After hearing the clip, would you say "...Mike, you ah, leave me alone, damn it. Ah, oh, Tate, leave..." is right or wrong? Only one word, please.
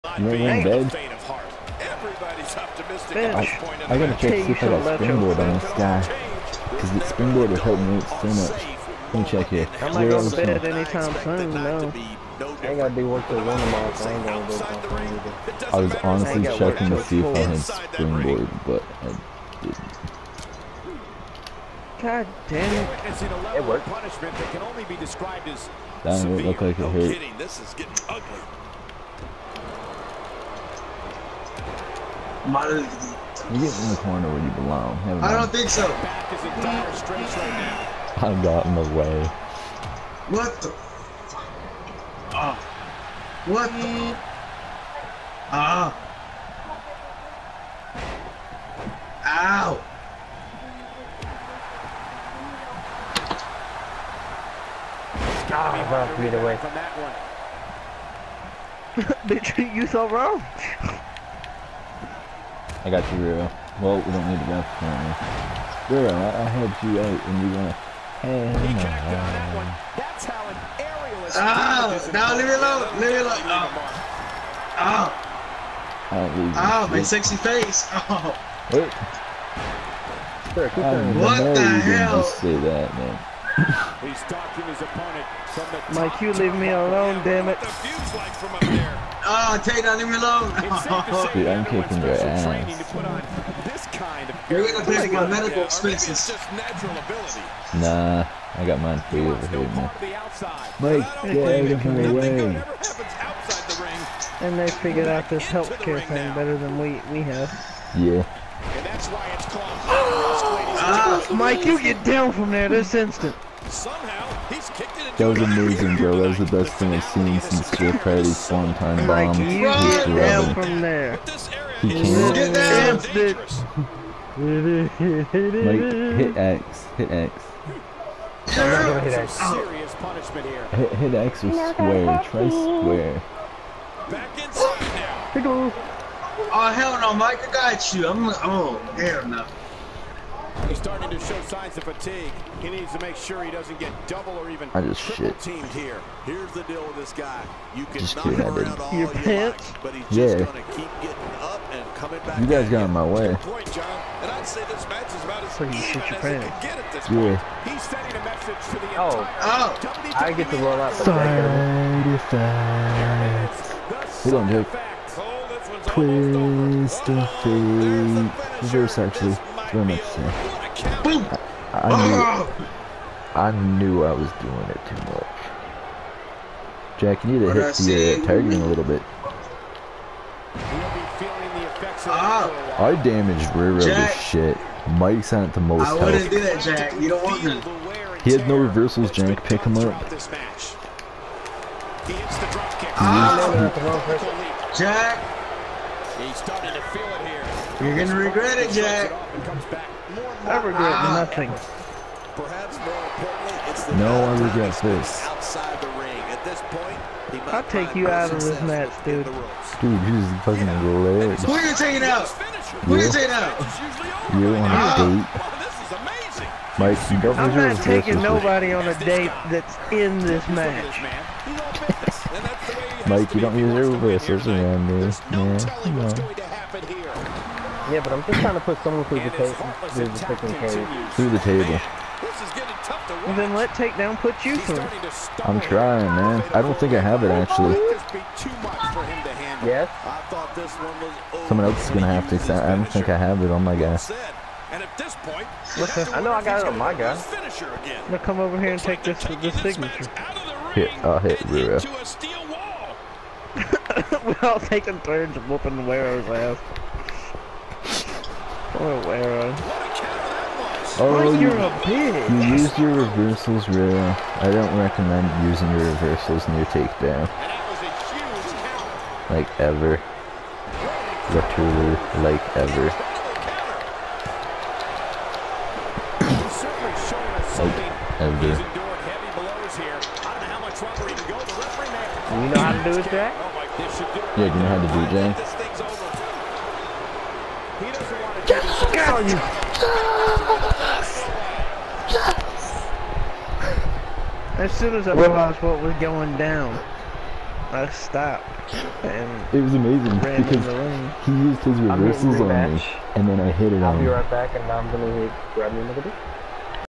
right.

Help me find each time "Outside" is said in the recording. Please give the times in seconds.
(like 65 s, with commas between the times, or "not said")
205 s.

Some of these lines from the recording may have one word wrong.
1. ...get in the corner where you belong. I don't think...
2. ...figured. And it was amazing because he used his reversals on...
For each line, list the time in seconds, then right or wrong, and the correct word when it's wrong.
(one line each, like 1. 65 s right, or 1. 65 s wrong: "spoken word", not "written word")
1. 32 s right
2. 297 s wrong: "stopped", not "figured".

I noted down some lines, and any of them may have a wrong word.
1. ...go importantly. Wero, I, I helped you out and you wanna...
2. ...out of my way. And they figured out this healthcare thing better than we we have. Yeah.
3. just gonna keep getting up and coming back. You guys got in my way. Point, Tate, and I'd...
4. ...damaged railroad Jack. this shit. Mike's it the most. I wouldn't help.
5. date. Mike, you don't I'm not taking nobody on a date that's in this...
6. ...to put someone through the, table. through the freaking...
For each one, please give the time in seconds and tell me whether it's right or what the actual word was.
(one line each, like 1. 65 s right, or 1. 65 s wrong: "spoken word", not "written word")
1. 64 s wrong: "currently", not "importantly"
2. 101 s right
3. 150 s wrong: "John", not "Tate"
4. 183 s right
5. 215 s right
6. 228 s right.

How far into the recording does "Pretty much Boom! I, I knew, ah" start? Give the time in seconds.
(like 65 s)
169 s.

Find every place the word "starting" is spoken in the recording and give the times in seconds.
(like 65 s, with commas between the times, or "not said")
140 s, 196 s.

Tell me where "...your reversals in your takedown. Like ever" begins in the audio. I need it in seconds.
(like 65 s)
265 s.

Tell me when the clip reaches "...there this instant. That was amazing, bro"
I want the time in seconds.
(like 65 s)
112 s.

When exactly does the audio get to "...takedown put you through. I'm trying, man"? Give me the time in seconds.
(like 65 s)
233 s.